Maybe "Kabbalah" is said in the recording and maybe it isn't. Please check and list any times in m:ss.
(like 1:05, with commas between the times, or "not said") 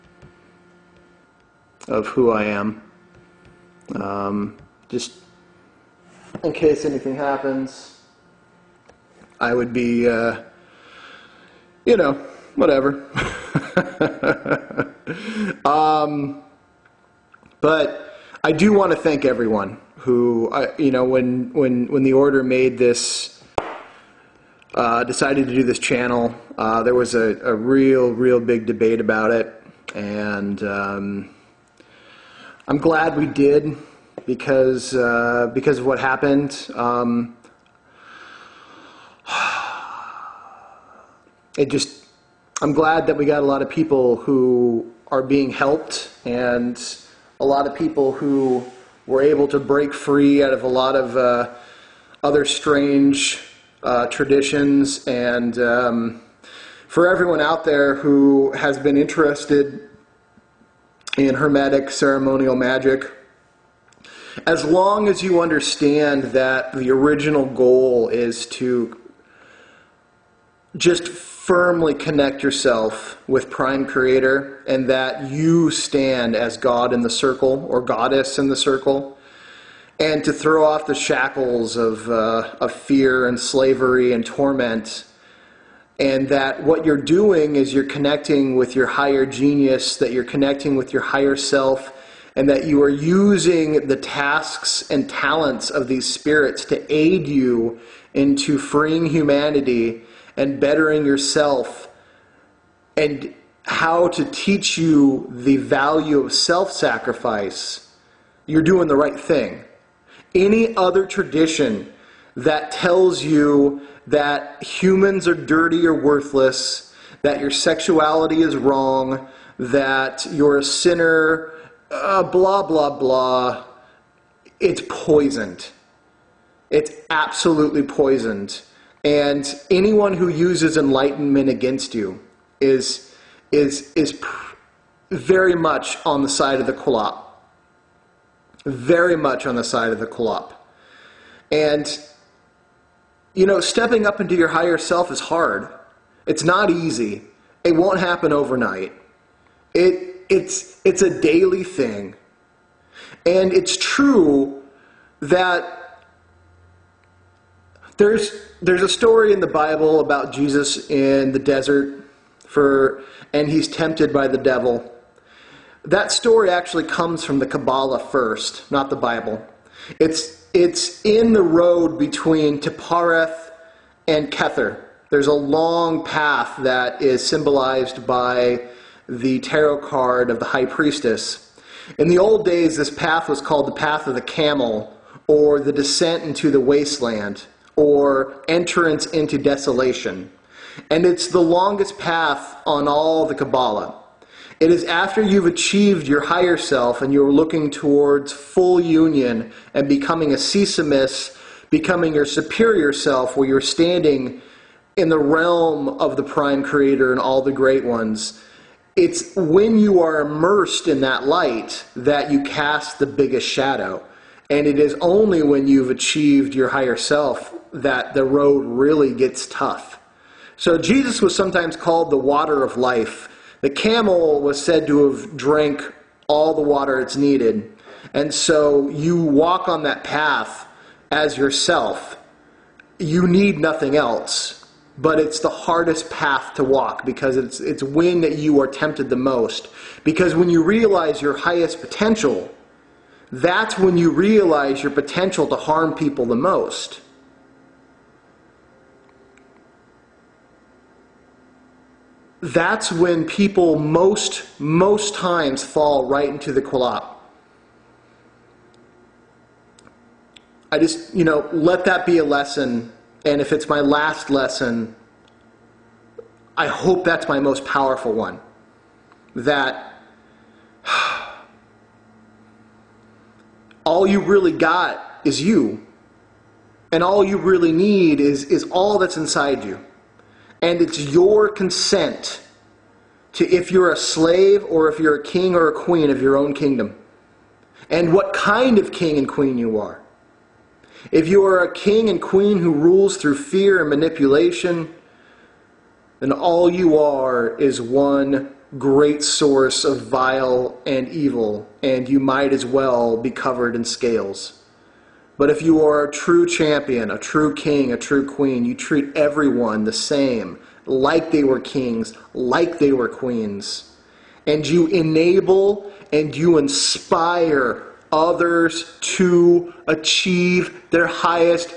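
2:47, 3:13.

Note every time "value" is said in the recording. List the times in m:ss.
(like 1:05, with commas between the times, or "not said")
1:45.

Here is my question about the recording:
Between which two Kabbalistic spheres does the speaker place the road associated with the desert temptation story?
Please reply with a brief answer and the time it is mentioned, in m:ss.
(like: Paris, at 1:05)
Tiphareth and Kether, at 2:52.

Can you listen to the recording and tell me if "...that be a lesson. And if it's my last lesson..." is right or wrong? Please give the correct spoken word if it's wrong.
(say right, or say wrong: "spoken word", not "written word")
right.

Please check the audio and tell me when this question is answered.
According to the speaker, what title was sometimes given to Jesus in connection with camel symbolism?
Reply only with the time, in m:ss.
3:42.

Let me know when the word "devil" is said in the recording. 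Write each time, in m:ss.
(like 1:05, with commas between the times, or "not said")
2:44.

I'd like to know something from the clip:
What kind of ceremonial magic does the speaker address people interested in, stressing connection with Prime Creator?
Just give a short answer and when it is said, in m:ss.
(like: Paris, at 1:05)
Hermetic, at 1:01.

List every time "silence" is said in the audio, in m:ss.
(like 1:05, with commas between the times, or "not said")
not said.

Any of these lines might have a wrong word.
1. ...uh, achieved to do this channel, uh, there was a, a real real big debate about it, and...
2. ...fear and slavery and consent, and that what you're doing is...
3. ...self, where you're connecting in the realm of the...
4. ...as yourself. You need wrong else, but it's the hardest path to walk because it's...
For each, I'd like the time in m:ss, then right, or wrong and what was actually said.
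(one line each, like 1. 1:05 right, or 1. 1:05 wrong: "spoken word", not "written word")
1. 0:24 wrong: "decided", not "achieved"
2. 1:22 wrong: "torment", not "consent"
3. 3:22 wrong: "standing", not "connecting"
4. 3:51 wrong: "nothing", not "wrong".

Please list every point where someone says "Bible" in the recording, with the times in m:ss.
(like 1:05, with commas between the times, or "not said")
2:39, 2:48.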